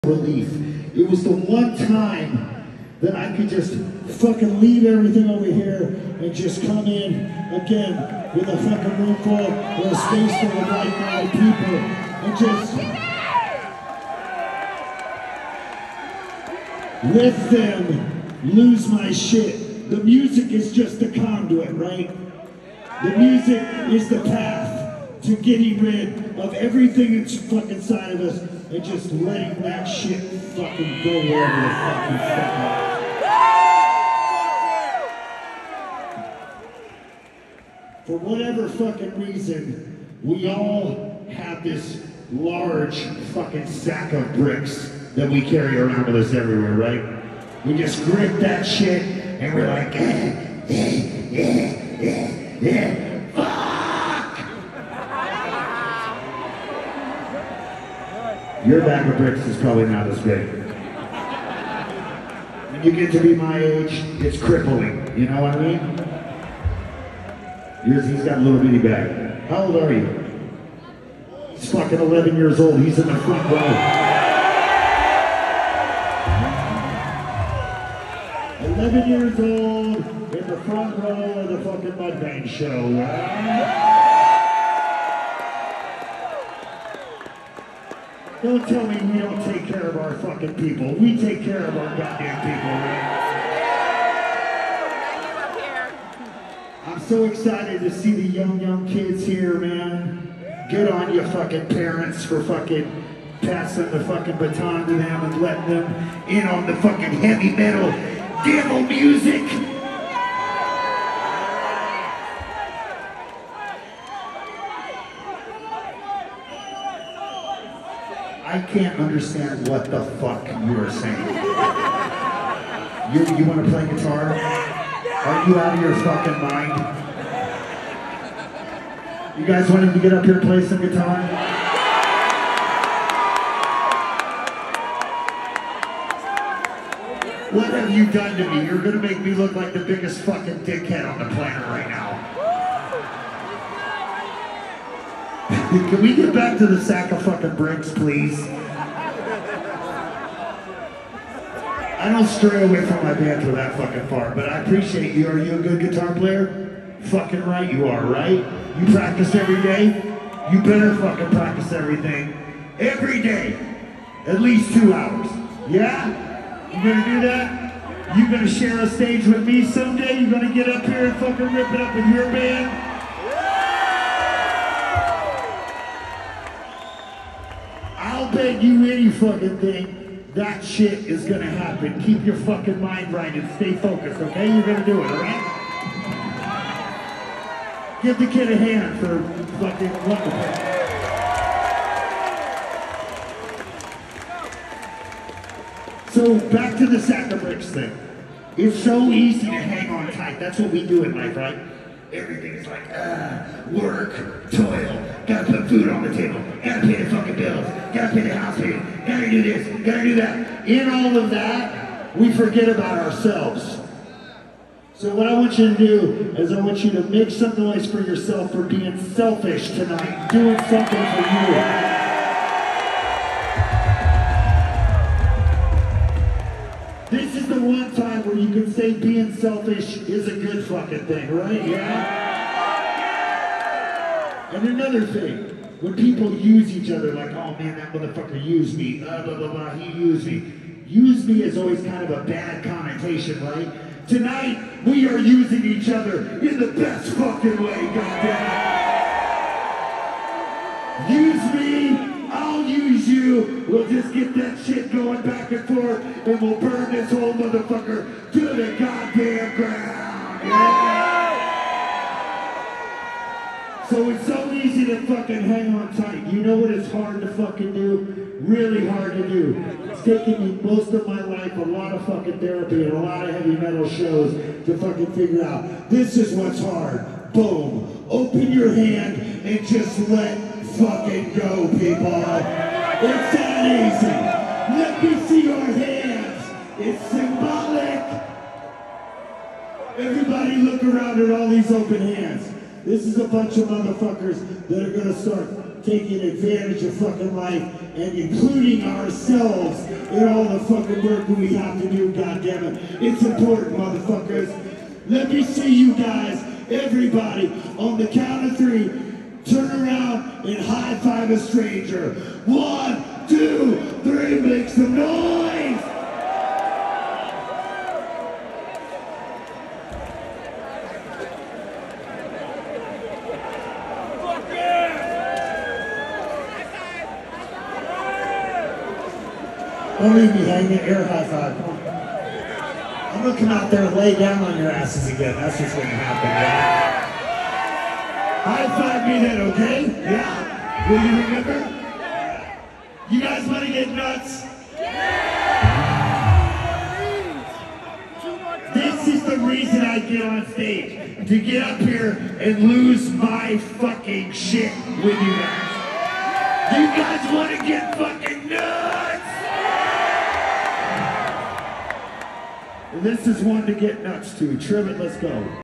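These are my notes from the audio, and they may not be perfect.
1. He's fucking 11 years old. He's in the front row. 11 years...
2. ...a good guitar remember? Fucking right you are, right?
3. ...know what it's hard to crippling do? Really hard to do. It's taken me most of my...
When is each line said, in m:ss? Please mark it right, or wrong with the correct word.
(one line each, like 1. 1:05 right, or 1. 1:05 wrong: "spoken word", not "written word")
1. 1:11 right
2. 2:35 wrong: "player", not "remember"
3. 4:26 wrong: "fucking", not "crippling".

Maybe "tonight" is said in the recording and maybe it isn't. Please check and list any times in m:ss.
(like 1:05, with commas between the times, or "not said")
3:39, 4:04.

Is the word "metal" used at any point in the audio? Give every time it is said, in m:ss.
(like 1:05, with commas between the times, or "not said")
1:47, 4:33.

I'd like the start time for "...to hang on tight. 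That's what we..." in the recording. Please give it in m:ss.
3:19.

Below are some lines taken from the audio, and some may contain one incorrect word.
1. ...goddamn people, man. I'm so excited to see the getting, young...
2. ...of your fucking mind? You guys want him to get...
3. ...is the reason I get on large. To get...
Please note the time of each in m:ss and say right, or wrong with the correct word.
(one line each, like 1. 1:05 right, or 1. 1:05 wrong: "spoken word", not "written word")
1. 1:31 wrong: "young", not "getting"
2. 2:05 right
3. 5:49 wrong: "stage", not "large".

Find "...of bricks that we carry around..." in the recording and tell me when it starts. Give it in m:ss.
0:44.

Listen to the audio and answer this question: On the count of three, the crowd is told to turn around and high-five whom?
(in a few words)
a stranger.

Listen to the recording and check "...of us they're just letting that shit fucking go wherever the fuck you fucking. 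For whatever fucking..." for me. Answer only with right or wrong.
right.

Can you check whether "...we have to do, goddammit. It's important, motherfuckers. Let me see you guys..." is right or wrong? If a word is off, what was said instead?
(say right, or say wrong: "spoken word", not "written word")
right.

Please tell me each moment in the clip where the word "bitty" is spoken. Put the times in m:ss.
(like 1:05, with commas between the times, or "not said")
1:08.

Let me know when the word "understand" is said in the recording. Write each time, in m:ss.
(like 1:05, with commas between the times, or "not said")
1:58.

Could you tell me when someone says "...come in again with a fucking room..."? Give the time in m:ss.
0:06.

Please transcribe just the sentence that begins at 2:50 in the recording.
You gonna get up here and fucking rip it up with your band?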